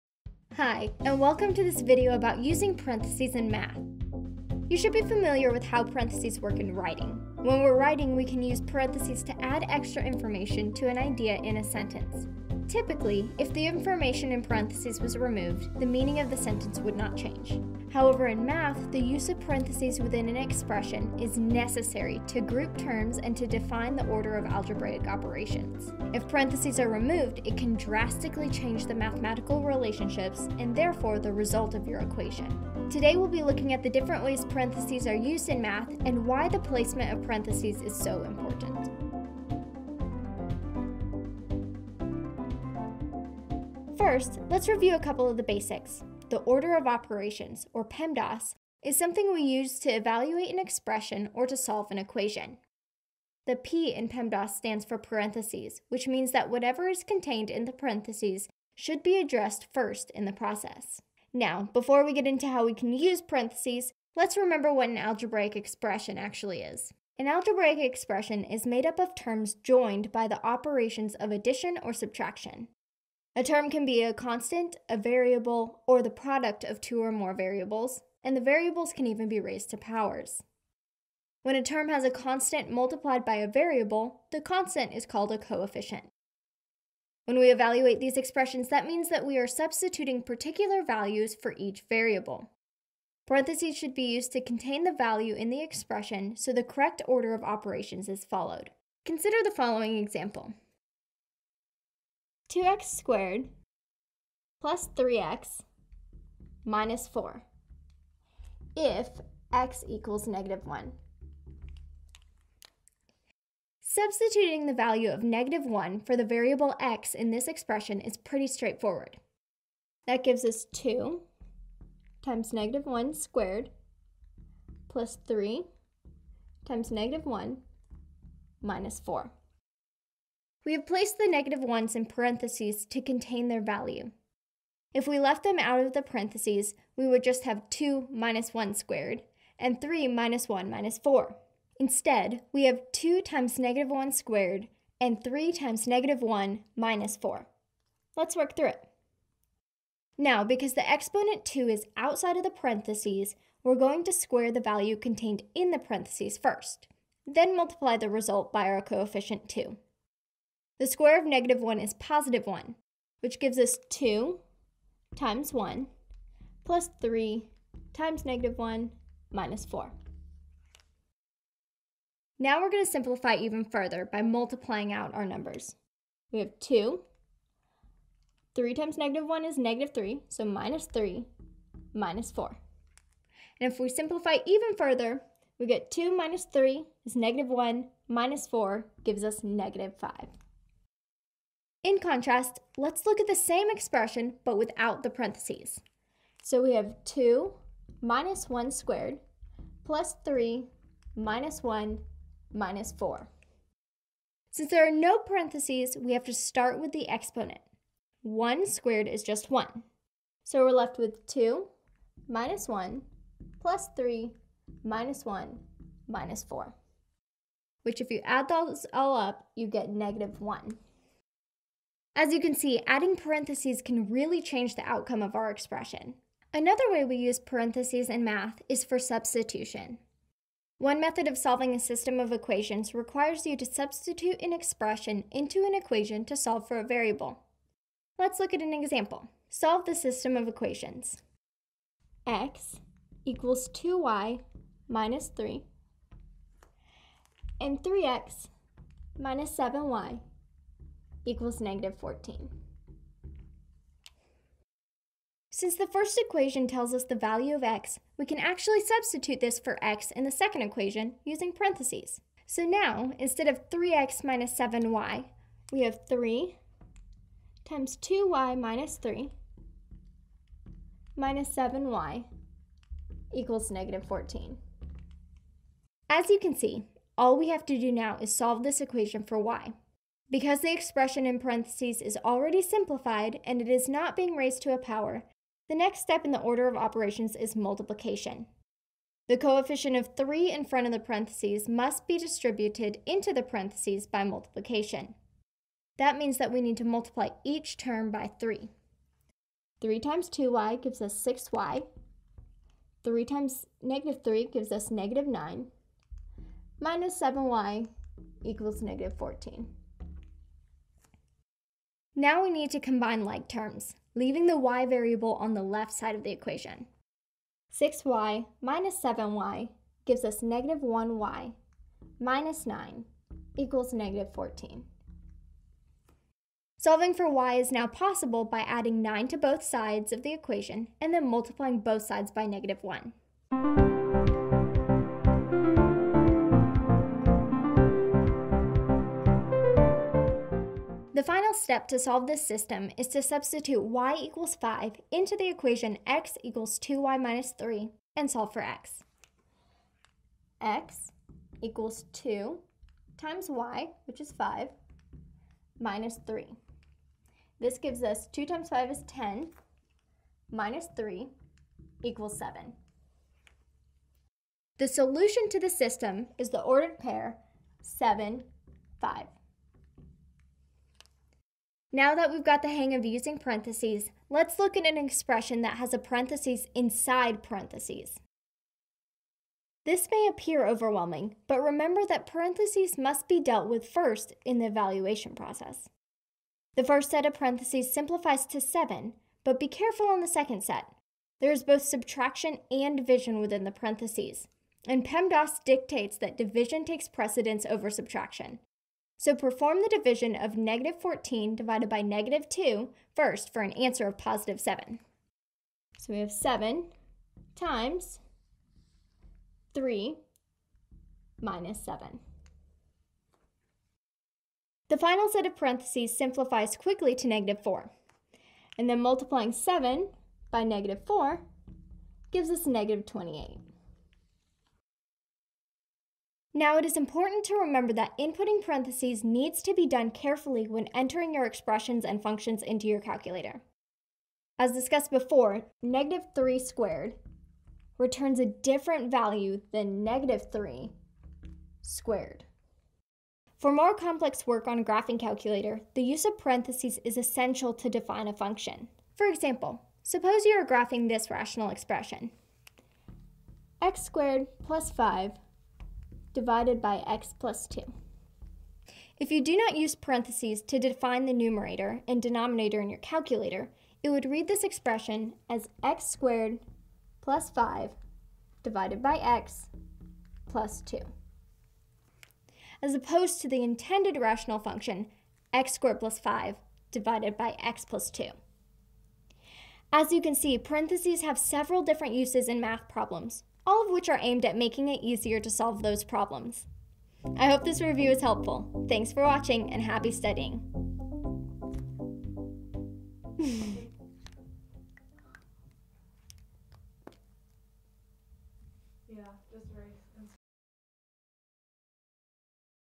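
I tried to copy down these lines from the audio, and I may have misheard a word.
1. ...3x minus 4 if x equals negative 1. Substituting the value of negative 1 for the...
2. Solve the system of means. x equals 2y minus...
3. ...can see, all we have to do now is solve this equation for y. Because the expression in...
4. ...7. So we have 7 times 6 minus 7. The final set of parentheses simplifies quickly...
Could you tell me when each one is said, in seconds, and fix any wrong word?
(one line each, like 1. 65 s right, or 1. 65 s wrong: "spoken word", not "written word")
1. 104 s right
2. 239 s wrong: "equations", not "means"
3. 276 s right
4. 404 s wrong: "3", not "6".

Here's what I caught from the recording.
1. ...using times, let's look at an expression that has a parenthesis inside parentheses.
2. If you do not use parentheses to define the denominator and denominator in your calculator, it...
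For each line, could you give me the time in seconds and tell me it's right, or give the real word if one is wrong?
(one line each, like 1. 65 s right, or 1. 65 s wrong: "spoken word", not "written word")
1. 373 s wrong: "parentheses", not "times"
2. 459 s wrong: "numerator", not "denominator".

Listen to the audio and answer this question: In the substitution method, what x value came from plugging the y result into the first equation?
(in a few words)
7.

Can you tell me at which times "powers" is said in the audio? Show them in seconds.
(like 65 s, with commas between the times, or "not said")
79 s, 284 s.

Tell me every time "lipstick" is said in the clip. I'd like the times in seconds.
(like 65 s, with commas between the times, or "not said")
not said.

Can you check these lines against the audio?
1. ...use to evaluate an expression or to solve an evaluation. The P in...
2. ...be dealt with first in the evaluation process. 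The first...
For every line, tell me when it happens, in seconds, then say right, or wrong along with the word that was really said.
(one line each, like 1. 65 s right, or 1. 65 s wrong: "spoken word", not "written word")
1. 49 s wrong: "equation", not "evaluation"
2. 383 s right.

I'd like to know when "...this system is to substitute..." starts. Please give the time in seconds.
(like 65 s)
342 s.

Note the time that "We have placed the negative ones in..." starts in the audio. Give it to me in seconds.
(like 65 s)
130 s.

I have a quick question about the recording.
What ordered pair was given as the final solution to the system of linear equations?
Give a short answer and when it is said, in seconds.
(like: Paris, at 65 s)
(7, 5), at 367 s.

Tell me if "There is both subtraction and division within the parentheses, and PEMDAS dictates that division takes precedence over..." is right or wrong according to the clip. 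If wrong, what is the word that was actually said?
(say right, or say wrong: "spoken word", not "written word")
right.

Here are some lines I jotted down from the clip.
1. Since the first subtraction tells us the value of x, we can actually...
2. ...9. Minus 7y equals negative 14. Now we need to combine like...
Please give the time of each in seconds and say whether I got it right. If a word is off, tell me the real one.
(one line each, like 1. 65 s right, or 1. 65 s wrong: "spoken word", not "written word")
1. 255 s wrong: "equation", not "subtraction"
2. 305 s right.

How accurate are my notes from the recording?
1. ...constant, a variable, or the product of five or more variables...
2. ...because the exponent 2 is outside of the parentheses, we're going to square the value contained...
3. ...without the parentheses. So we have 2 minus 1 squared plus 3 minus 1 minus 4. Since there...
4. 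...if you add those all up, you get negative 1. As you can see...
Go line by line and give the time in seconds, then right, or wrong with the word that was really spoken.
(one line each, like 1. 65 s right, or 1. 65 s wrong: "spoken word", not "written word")
1. 74 s wrong: "two", not "five"
2. 150 s right
3. 194 s right
4. 218 s right.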